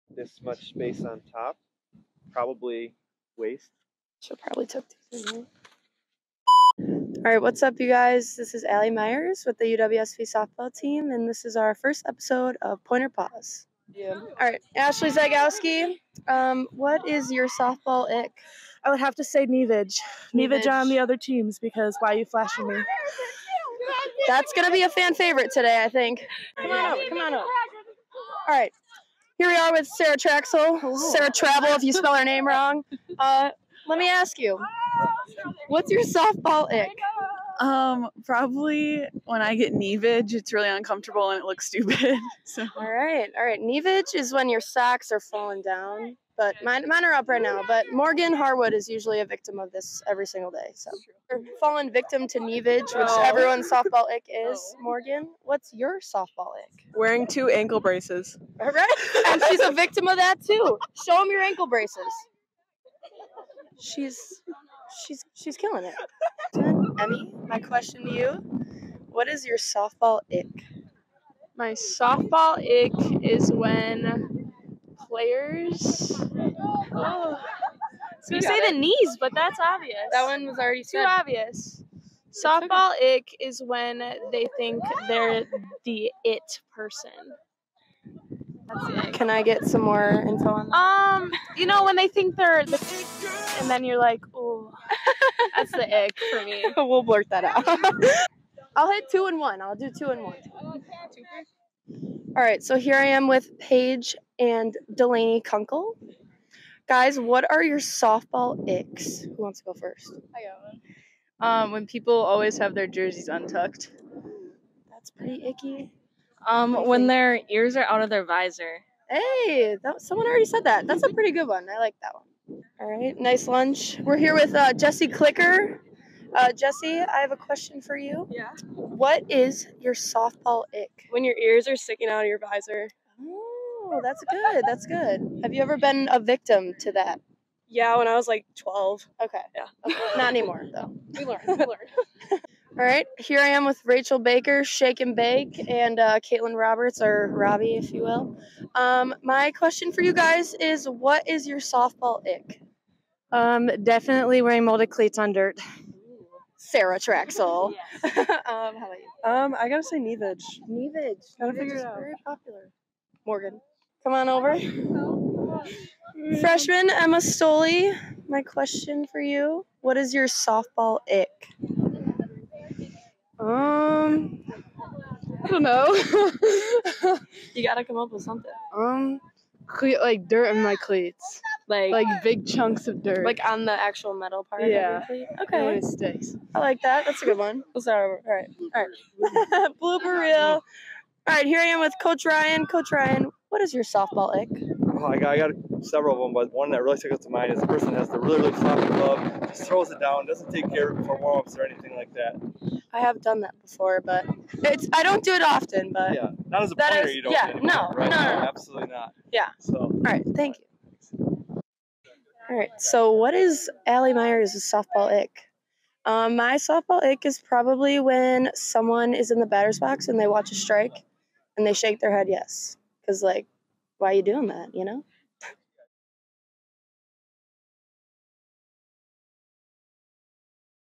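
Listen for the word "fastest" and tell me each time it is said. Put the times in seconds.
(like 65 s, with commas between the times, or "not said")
not said.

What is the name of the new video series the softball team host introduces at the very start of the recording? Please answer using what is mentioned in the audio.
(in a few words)
Pointer Pause.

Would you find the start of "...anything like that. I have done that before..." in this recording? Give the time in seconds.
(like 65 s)
201 s.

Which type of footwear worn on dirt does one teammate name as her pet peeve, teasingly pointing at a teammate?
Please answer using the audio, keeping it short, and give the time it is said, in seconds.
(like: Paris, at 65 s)
Molded cleats, at 154 s.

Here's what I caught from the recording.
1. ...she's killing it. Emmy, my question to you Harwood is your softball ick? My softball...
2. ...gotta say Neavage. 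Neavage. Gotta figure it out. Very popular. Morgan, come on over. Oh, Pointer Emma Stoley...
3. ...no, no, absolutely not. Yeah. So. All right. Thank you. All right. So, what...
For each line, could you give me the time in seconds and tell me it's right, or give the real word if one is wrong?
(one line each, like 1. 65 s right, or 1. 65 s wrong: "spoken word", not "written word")
1. 65 s wrong: "What", not "Harwood"
2. 159 s wrong: "Freshman", not "Pointer"
3. 208 s right.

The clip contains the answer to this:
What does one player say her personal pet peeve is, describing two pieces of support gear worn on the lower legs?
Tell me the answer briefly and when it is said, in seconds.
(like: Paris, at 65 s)
Wearing two ankle braces, at 56 s.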